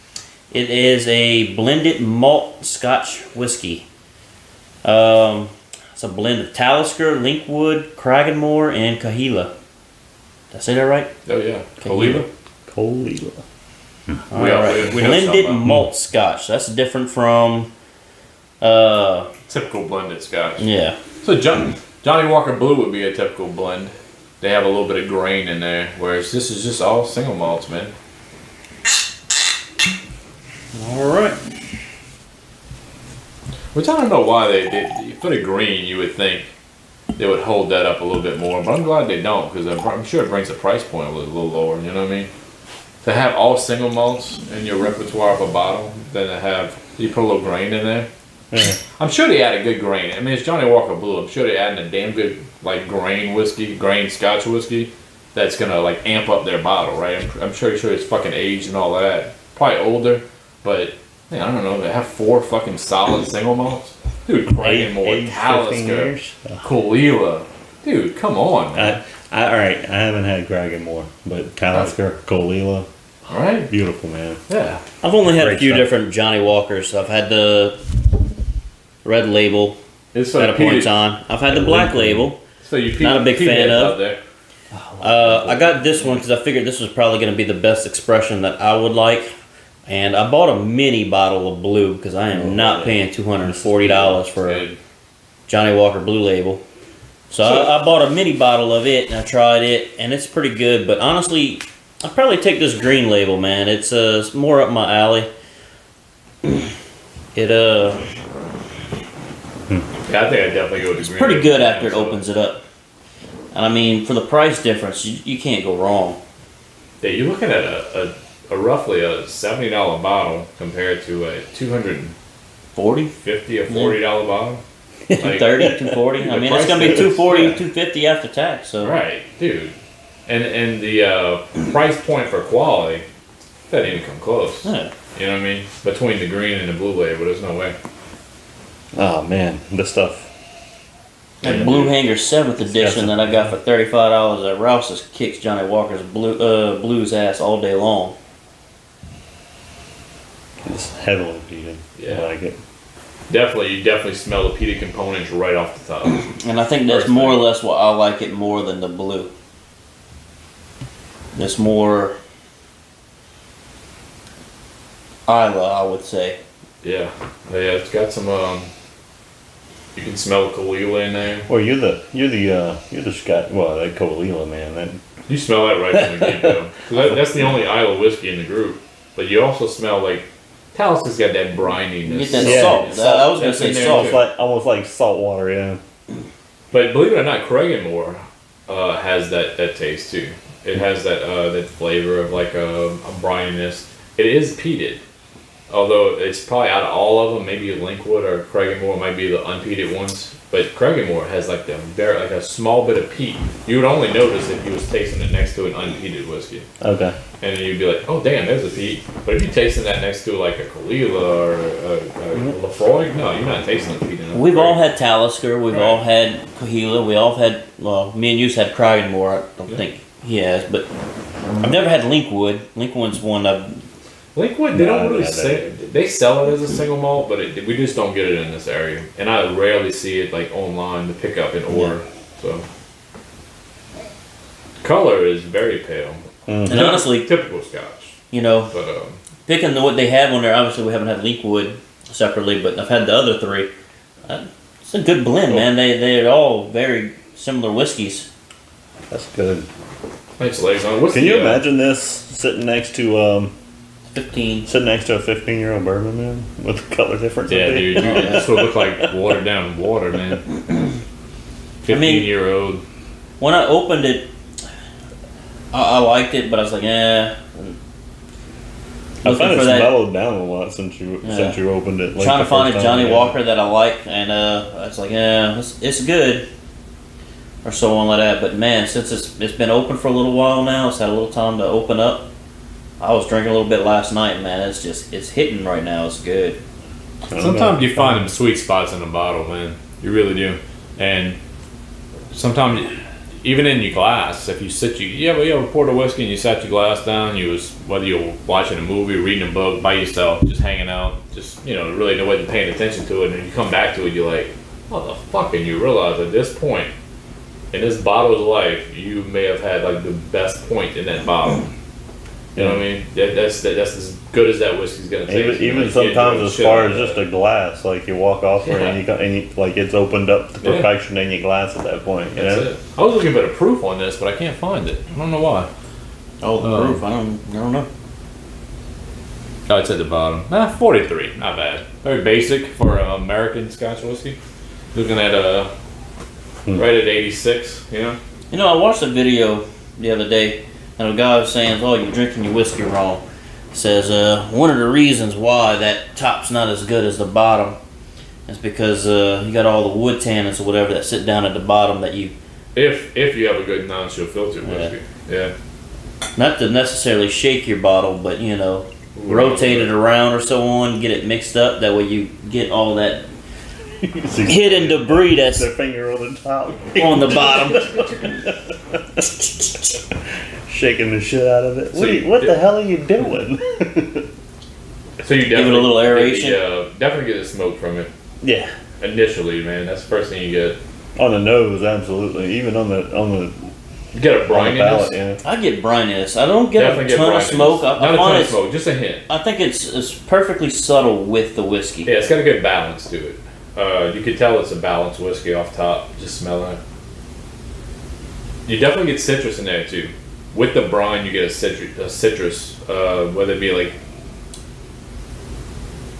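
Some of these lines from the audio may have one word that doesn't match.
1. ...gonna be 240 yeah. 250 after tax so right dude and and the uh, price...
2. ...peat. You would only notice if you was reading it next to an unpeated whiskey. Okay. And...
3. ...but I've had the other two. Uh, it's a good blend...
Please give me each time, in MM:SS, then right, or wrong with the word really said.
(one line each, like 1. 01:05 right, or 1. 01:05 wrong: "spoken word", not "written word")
1. 02:06 right
2. 03:23 wrong: "tasting", not "reading"
3. 04:02 wrong: "three", not "two".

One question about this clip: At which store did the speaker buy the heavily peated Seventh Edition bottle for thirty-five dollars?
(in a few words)
Rouse's.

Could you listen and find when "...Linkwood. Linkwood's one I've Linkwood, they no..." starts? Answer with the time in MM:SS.
03:42.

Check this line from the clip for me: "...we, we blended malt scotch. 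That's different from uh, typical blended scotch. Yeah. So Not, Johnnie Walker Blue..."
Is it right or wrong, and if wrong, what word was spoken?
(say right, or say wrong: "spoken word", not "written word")
wrong: "John", not "Not".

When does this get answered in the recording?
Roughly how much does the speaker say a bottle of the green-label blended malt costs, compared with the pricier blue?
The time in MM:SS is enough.
01:59.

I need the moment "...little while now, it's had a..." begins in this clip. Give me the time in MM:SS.
04:40.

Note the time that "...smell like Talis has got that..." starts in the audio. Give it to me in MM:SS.
02:59.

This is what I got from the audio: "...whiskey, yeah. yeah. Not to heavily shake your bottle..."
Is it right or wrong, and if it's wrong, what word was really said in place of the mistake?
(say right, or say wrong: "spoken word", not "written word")
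wrong: "necessarily", not "heavily".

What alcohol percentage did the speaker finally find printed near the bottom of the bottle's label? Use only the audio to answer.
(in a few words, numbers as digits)
43%.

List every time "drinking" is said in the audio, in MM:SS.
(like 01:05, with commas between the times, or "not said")
04:43, 05:42.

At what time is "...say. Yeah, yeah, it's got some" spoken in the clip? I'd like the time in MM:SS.
02:46.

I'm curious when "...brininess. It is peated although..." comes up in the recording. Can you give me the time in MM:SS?
03:13.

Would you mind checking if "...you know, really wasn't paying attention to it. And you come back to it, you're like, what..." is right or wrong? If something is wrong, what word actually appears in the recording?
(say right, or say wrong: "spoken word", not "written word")
right.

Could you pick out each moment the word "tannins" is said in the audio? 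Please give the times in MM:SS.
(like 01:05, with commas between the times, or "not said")
05:50.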